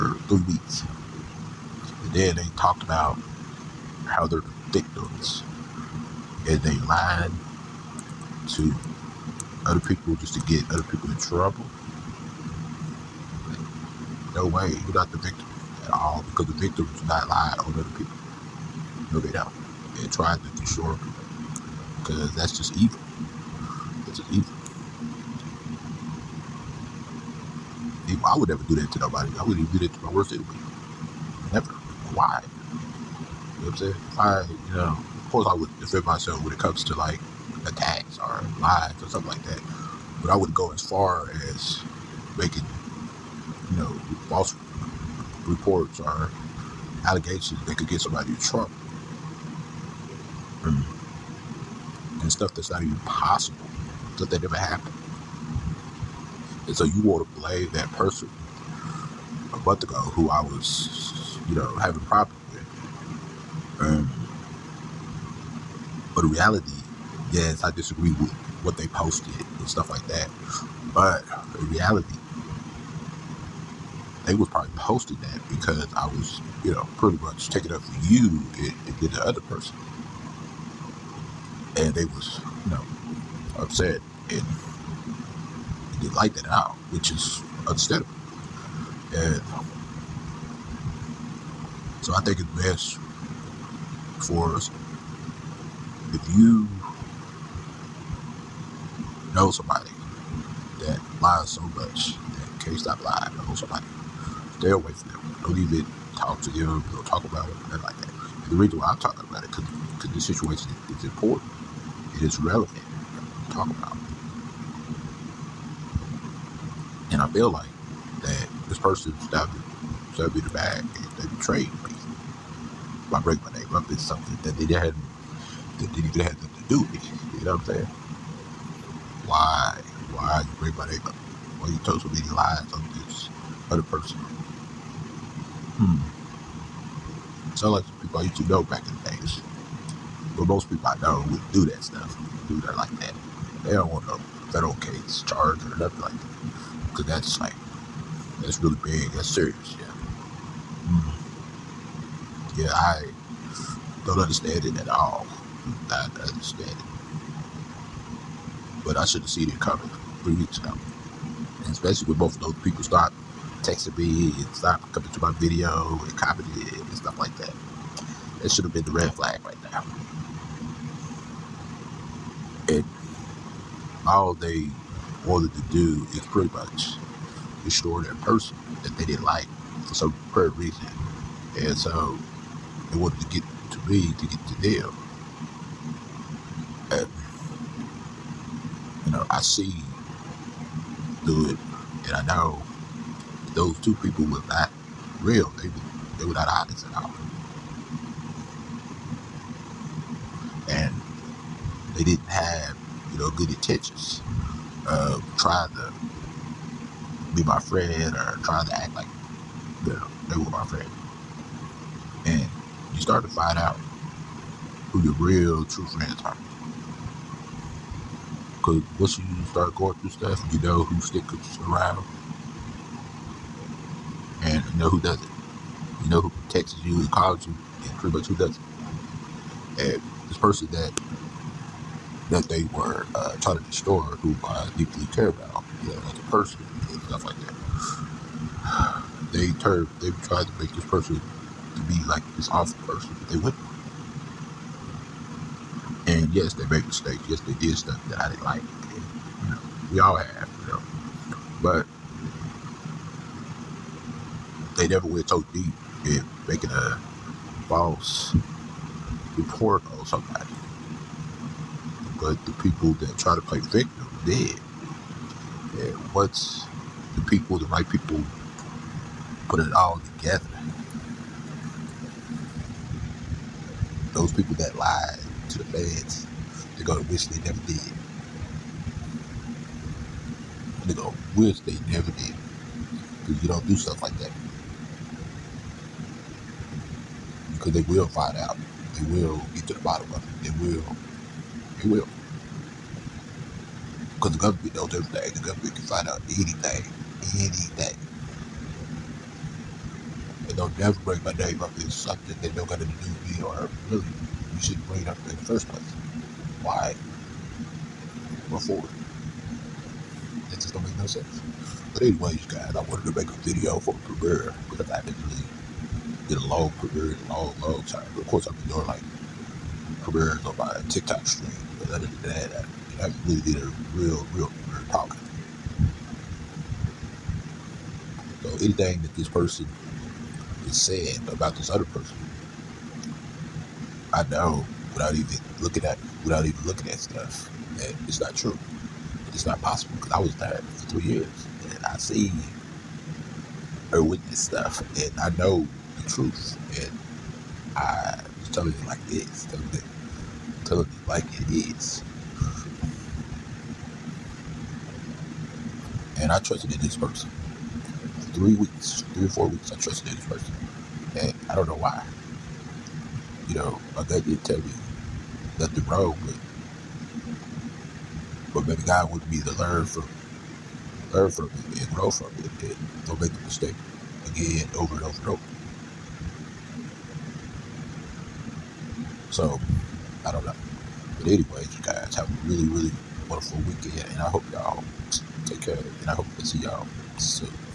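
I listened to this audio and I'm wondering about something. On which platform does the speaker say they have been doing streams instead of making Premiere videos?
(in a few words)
TikTok.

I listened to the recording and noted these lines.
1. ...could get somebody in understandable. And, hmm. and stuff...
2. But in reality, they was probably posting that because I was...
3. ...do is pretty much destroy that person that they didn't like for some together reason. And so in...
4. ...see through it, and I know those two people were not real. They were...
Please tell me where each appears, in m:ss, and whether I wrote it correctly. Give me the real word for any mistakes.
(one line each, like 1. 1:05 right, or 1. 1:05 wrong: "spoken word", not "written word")
1. 0:47 wrong: "trouble", not "understandable"
2. 1:10 right
3. 2:55 wrong: "prayer", not "together"
4. 3:09 right.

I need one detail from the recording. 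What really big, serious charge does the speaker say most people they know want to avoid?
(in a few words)
federal case charge.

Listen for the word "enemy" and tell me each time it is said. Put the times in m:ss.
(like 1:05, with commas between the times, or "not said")
0:30.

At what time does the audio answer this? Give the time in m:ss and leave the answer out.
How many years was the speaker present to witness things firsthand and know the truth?
5:40.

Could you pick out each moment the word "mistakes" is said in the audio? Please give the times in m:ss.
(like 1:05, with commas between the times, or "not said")
4:06, 6:13.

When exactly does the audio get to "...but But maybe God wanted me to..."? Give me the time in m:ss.
6:06.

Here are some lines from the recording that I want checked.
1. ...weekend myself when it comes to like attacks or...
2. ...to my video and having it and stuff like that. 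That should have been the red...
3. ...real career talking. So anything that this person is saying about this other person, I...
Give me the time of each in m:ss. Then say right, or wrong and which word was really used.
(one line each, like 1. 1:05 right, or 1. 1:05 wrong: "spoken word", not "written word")
1. 0:35 wrong: "defend", not "weekend"
2. 2:45 wrong: "copying", not "having"
3. 5:24 right.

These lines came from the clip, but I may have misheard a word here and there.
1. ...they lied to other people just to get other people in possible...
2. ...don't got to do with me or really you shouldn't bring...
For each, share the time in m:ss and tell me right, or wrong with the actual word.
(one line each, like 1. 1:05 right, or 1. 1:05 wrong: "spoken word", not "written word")
1. 0:06 wrong: "trouble", not "possible"
2. 5:02 right.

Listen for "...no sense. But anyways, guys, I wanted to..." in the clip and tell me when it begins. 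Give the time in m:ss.
5:10.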